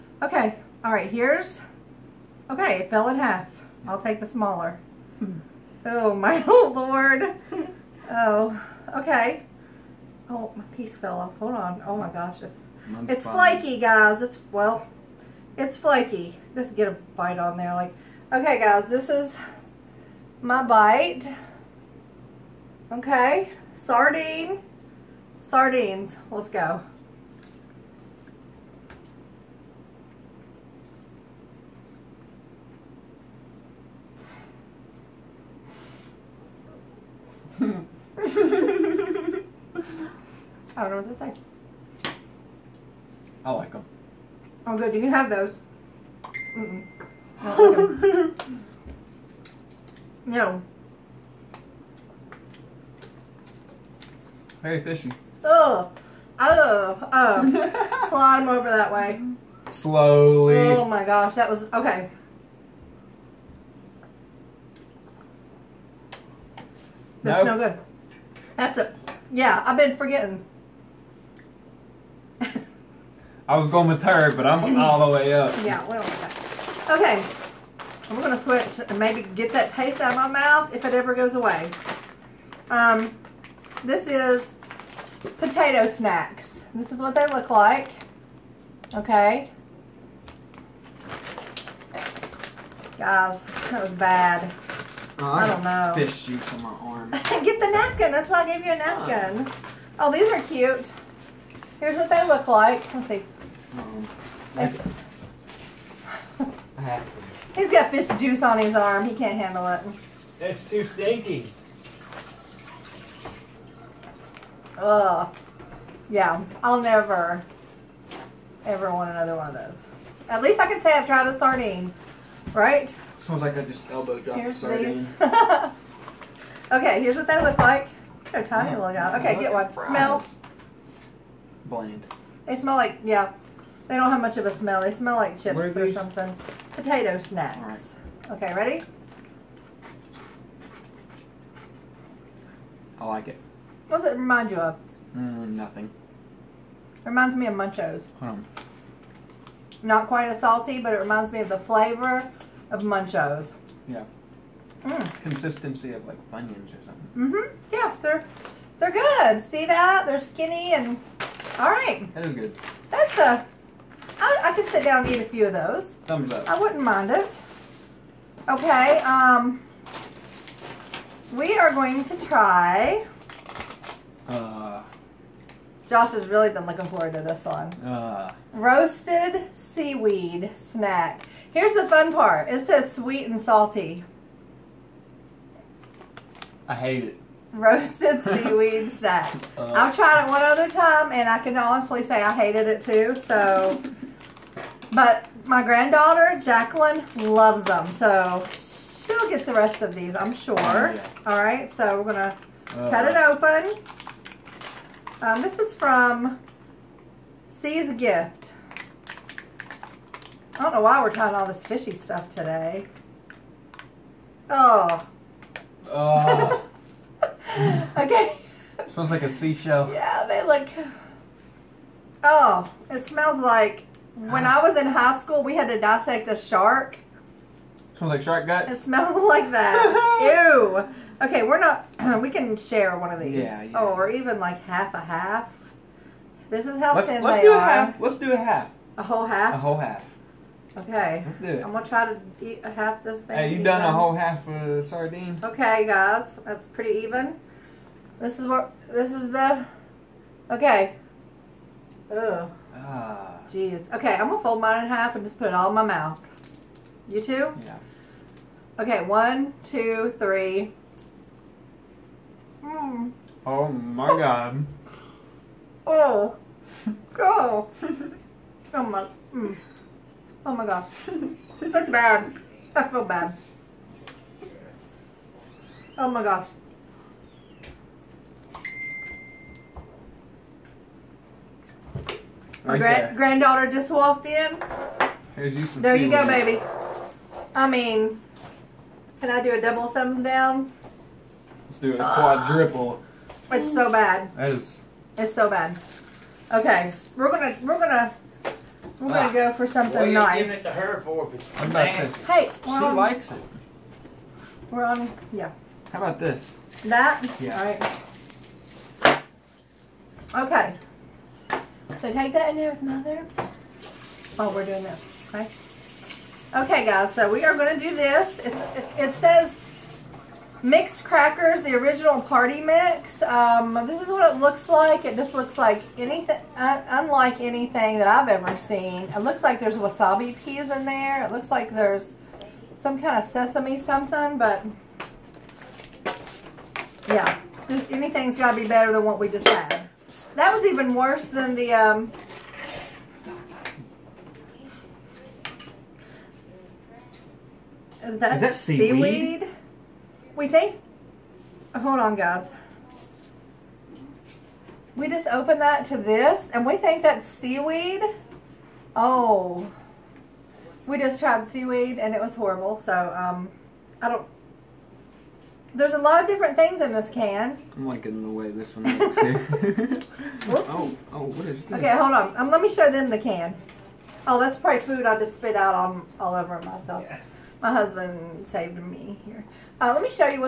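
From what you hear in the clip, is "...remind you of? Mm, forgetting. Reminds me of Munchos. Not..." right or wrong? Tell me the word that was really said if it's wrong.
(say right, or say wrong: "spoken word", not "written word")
wrong: "nothing", not "forgetting".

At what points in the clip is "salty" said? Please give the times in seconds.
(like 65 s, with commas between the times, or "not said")
150 s, 183 s.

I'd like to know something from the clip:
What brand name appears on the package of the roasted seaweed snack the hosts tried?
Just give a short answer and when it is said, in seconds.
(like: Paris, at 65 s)
Sea's Gift, at 207 s.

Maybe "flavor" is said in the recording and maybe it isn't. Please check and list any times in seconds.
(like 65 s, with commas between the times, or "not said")
151 s.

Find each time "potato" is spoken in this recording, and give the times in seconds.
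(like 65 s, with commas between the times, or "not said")
85 s, 136 s.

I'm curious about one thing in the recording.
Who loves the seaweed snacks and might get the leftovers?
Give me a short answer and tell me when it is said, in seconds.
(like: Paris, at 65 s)
Jacqueline, at 196 s.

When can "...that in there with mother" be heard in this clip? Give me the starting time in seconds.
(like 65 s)
312 s.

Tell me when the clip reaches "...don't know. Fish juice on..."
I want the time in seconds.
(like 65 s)
95 s.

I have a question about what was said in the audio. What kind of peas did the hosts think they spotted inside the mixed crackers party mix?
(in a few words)
Wasabi peas.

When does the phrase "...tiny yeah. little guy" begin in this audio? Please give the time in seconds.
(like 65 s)
128 s.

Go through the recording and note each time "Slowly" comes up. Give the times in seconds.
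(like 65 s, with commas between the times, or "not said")
59 s.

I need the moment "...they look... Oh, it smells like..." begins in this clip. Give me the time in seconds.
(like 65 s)
220 s.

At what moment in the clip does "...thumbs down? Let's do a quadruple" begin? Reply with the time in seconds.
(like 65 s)
289 s.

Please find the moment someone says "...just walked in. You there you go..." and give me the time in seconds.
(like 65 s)
283 s.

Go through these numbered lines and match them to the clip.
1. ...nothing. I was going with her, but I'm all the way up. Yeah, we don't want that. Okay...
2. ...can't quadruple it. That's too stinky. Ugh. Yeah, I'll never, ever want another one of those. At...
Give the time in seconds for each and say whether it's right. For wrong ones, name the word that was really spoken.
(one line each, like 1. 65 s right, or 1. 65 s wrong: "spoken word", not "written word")
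1. 69 s wrong: "forgetting", not "nothing"
2. 109 s wrong: "handle", not "quadruple".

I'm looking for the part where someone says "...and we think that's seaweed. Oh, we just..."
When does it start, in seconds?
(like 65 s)
356 s.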